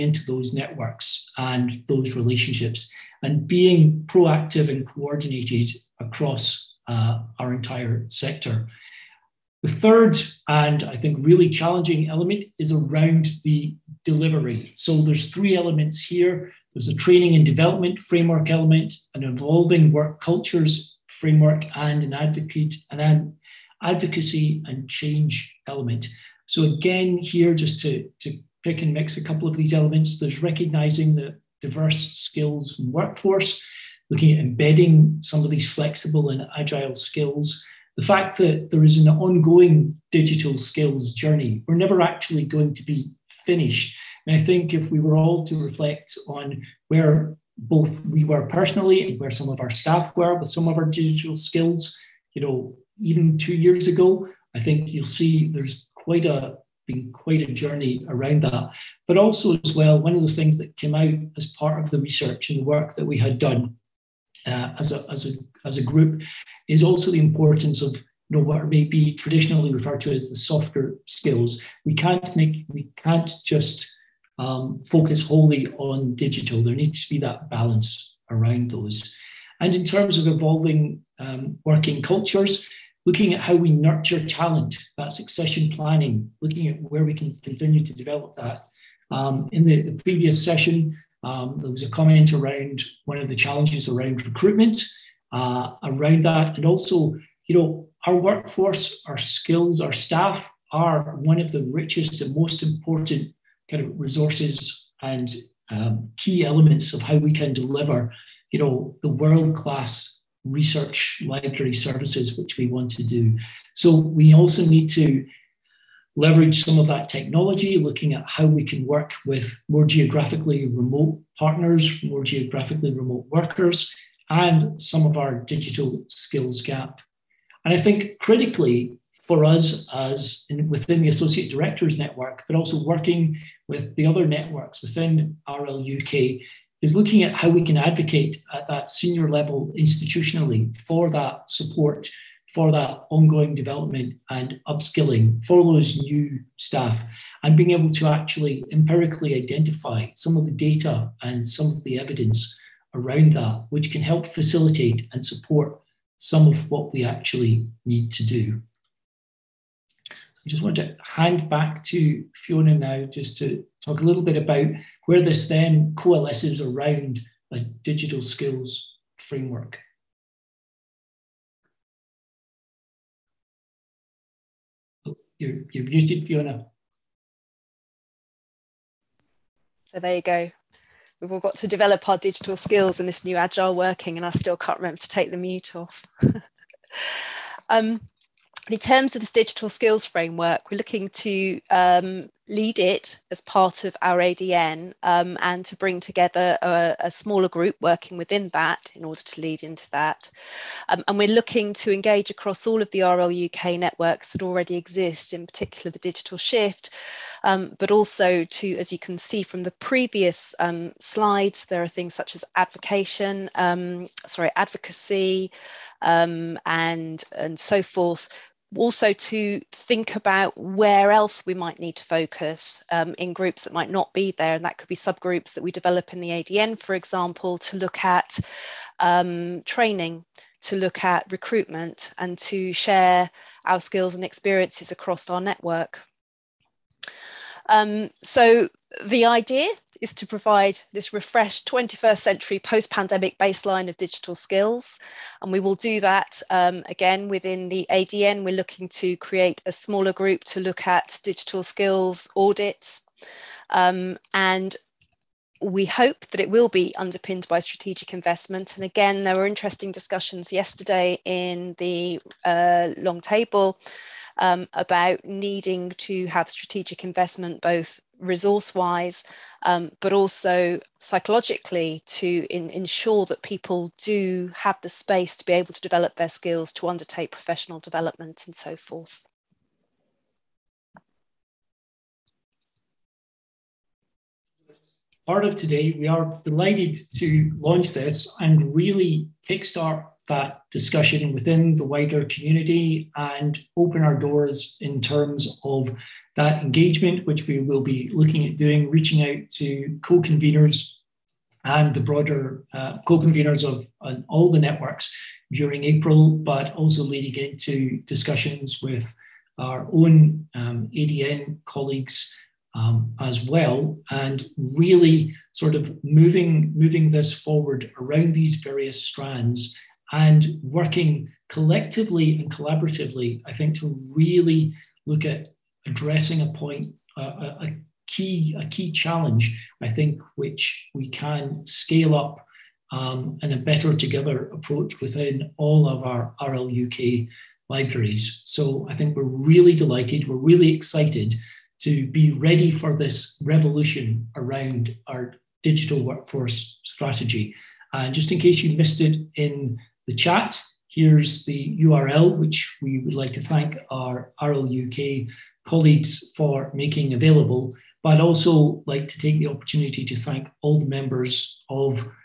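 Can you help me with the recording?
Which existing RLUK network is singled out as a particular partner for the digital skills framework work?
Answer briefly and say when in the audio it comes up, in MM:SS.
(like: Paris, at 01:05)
the digital shift, at 03:25.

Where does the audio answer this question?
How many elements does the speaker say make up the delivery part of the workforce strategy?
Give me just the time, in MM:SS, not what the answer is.
00:15.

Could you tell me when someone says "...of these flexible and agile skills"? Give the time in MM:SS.
00:35.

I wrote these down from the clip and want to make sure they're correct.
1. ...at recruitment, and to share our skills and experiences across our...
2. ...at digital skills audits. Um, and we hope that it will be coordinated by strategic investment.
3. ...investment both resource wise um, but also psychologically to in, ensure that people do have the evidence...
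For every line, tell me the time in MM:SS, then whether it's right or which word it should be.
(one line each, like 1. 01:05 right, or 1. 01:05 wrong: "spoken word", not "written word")
1. 03:51 right
2. 04:10 wrong: "underpinned", not "coordinated"
3. 04:27 wrong: "space", not "evidence".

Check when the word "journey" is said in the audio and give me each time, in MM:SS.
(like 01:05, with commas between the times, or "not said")
00:41, 00:57.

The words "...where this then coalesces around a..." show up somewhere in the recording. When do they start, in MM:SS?
02:45.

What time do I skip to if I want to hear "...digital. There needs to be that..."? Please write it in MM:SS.
01:16.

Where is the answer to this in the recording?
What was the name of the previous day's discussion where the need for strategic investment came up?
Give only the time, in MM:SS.
04:22.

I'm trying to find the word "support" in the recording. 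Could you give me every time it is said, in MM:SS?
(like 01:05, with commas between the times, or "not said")
02:21, 02:35.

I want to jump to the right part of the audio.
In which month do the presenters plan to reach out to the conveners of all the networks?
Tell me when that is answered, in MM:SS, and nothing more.
05:05.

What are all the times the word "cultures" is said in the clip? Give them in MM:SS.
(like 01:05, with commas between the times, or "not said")
00:20, 01:22.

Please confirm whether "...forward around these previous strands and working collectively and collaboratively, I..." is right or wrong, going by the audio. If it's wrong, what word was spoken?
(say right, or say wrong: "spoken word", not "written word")
wrong: "various", not "previous".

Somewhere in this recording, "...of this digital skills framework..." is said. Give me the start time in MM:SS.
03:09.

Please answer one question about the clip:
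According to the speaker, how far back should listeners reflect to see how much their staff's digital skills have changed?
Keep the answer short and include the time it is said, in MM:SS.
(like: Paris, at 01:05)
2 years, at 00:53.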